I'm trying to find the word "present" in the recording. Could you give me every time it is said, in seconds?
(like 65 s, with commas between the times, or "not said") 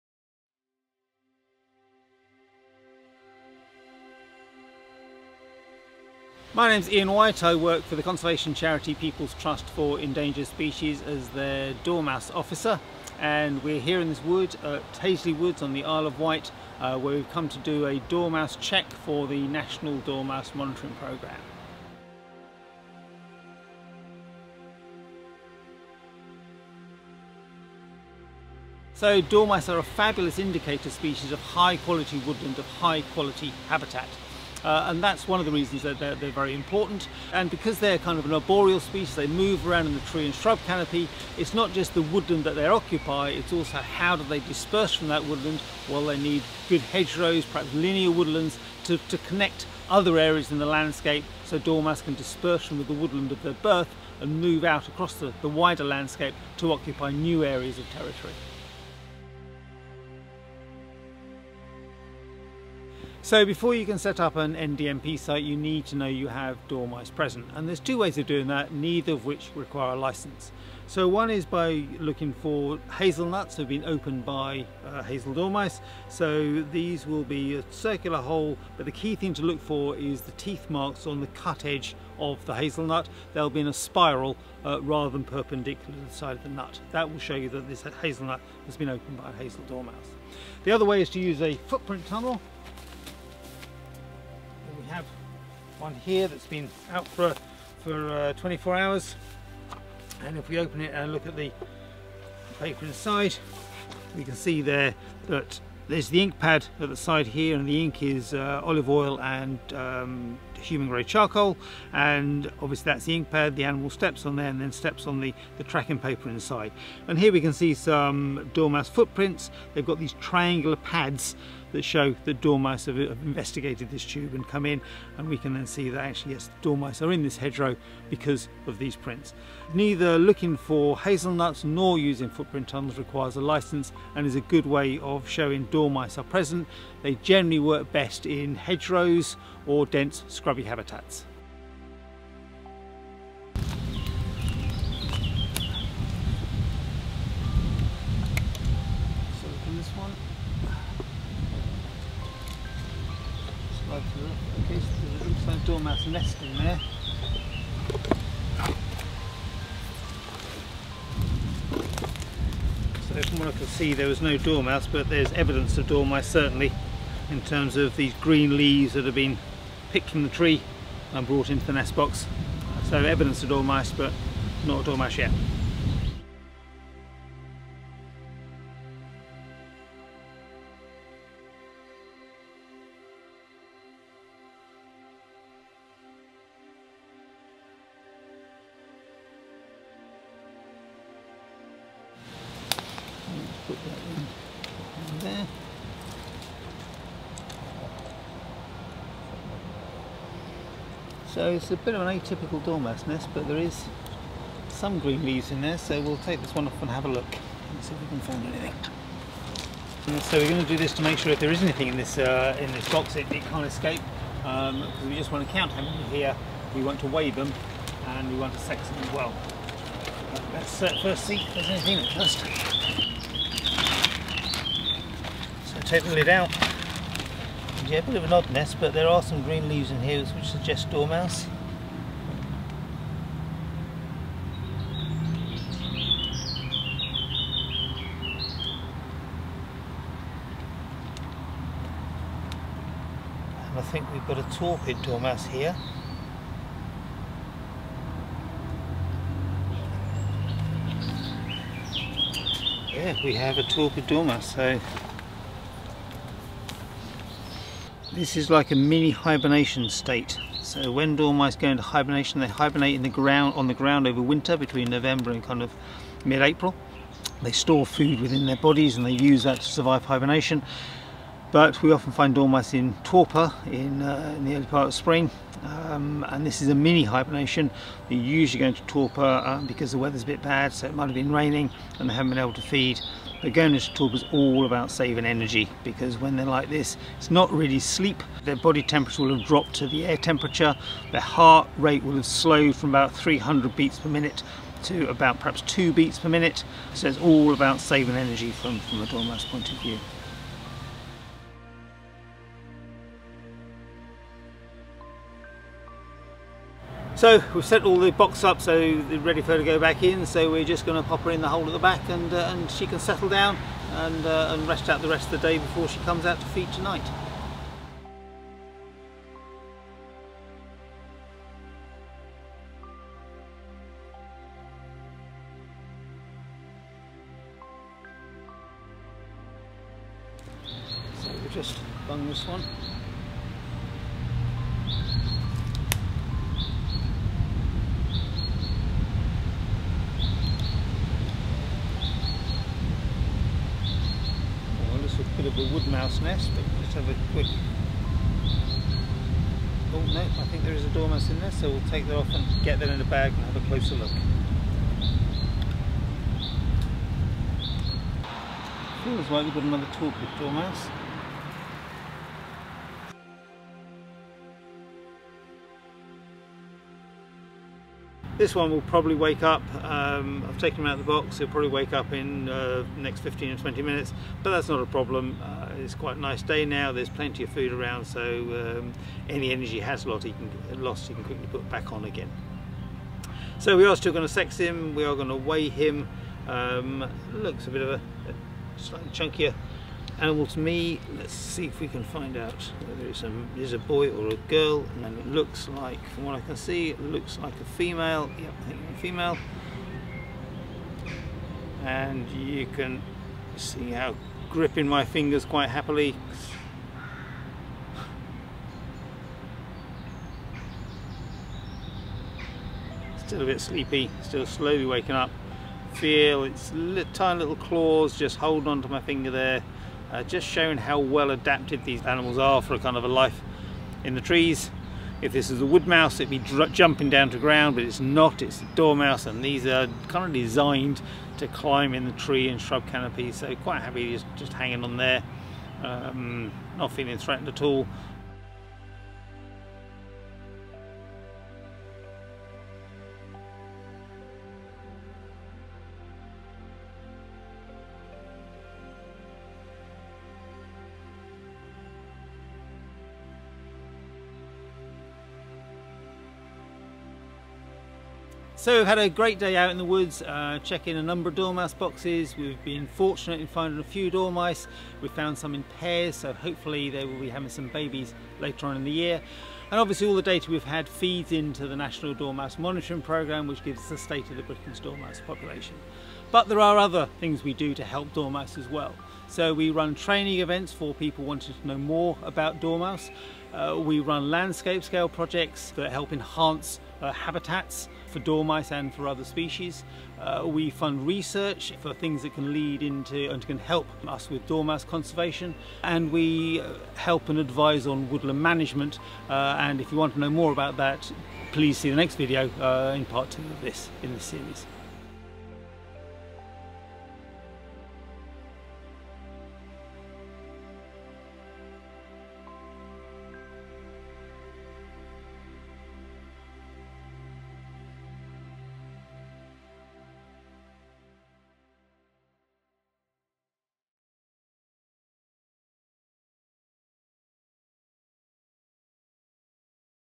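67 s, 136 s.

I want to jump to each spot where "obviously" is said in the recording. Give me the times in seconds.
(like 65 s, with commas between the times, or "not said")
112 s, 469 s.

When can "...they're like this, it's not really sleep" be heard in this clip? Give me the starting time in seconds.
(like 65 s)
286 s.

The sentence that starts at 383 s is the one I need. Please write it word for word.
So we are still going to sex him.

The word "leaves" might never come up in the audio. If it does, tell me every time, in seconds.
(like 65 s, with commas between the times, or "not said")
168 s, 205 s, 229 s.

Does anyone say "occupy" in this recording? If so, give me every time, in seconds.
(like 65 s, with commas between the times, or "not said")
42 s, 56 s.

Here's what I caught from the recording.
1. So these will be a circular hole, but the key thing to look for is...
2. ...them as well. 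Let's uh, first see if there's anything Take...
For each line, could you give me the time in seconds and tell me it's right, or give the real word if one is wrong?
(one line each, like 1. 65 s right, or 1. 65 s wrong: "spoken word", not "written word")
1. 76 s right
2. 218 s right.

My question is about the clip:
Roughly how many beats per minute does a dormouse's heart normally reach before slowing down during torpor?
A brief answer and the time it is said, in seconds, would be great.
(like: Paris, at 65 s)
300, at 292 s.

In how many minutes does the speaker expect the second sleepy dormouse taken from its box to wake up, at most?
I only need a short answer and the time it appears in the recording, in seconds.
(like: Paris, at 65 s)
20, at 373 s.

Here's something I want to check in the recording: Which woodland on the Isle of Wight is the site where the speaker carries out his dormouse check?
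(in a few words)
Hazley Woods.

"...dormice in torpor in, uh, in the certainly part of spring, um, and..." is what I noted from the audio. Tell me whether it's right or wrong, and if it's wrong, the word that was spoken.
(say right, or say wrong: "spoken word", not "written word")
wrong: "early", not "certainly".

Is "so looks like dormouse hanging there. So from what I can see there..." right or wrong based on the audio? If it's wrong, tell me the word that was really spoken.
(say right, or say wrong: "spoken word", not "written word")
wrong: "nesting", not "hanging".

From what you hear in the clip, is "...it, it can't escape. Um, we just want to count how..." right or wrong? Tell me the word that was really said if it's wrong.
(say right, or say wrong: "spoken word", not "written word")
right.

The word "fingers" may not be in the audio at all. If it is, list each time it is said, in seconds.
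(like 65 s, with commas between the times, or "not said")
405 s, 419 s.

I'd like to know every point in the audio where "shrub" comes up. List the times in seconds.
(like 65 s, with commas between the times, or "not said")
40 s, 432 s.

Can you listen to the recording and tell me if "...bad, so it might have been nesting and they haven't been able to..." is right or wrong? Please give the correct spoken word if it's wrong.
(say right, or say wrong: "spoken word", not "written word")
wrong: "raining", not "nesting".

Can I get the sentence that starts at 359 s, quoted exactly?
Feels like we've got another torpid dormouse.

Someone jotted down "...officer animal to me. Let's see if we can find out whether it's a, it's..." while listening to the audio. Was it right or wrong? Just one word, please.
wrong.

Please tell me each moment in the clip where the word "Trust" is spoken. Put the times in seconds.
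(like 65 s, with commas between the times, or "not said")
9 s.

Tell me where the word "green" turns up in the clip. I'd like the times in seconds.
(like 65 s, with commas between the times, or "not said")
168 s, 204 s, 229 s.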